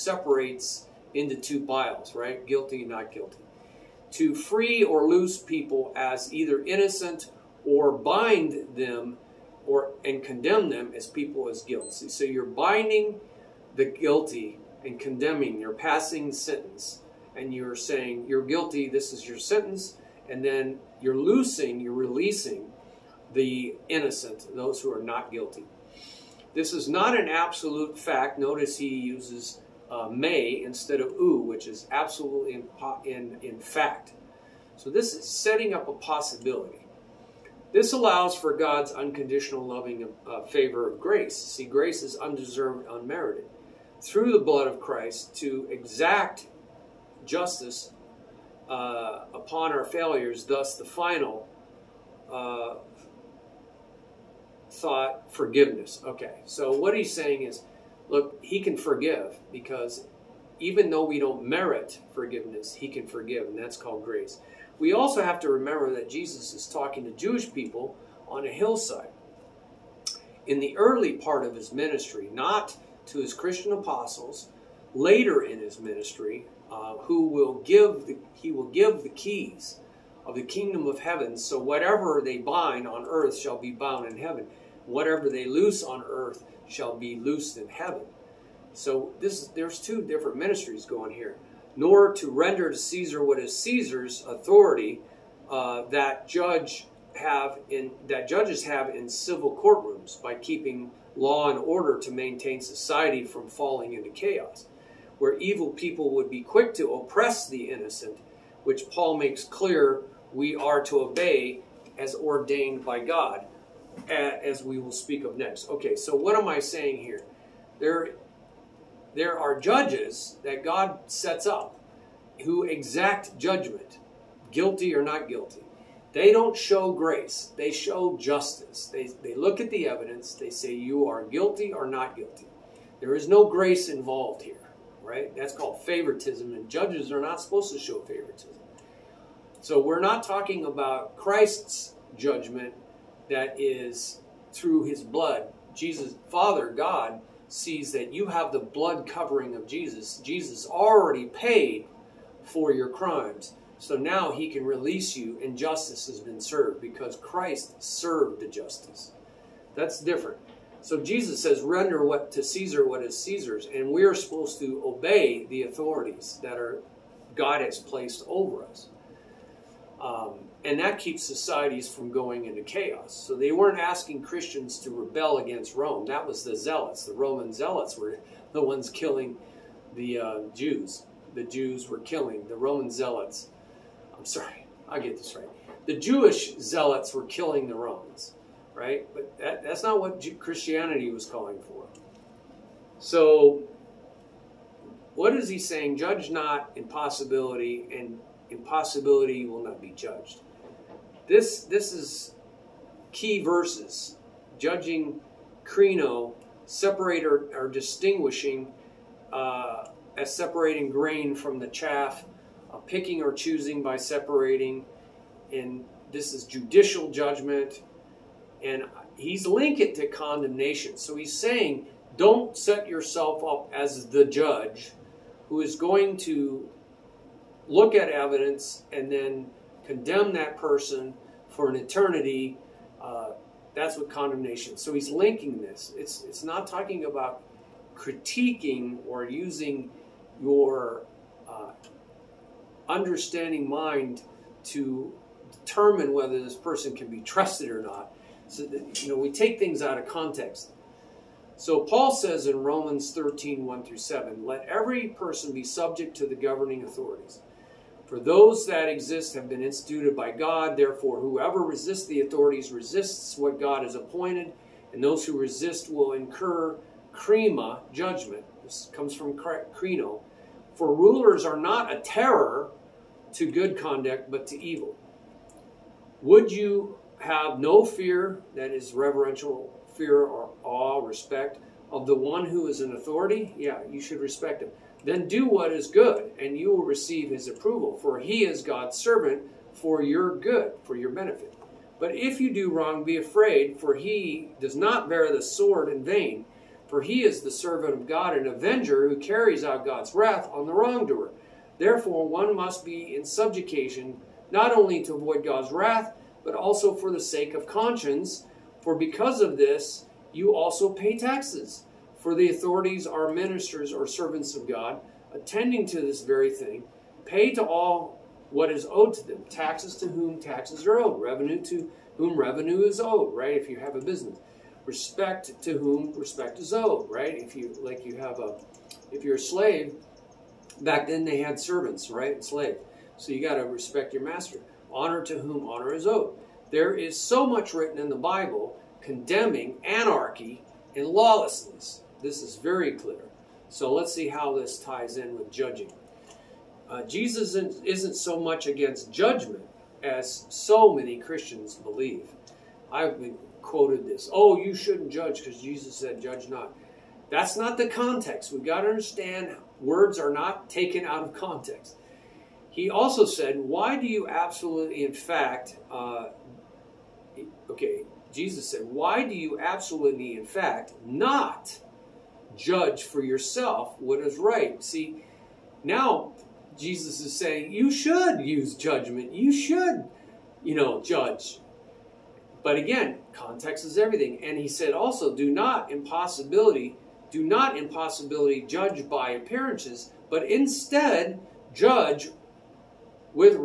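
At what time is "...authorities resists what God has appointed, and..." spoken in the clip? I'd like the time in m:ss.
4:22.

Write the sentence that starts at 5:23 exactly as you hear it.
If you have a business, respect to whom respect is owed, right?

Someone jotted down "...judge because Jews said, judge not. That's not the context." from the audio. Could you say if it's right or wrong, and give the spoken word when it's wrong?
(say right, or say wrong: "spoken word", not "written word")
wrong: "Jesus", not "Jews".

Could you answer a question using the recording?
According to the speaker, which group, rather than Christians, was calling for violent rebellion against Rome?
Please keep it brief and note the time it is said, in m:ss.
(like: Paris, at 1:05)
The Jewish zealots, at 3:05.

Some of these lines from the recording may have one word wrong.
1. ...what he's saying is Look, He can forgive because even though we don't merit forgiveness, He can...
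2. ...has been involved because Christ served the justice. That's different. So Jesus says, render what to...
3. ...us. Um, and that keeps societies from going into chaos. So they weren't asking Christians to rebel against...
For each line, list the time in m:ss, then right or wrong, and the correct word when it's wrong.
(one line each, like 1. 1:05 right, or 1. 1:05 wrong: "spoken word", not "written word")
1. 0:56 right
2. 2:36 wrong: "served", not "involved"
3. 2:48 right.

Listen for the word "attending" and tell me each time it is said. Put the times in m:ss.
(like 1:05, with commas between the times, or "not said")
5:15.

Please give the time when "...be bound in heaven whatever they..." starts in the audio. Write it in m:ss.
1:23.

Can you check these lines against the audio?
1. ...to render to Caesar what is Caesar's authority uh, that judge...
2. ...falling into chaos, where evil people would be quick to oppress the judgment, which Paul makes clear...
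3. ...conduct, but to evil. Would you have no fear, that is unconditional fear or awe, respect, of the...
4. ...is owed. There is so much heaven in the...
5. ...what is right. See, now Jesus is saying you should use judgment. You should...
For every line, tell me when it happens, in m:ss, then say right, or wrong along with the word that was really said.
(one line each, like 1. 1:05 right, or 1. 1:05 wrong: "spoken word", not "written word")
1. 1:32 right
2. 1:43 wrong: "innocent", not "judgment"
3. 4:33 wrong: "reverential", not "unconditional"
4. 5:35 wrong: "written", not "heaven"
5. 6:13 right.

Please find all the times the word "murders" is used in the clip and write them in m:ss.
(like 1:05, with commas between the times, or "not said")
not said.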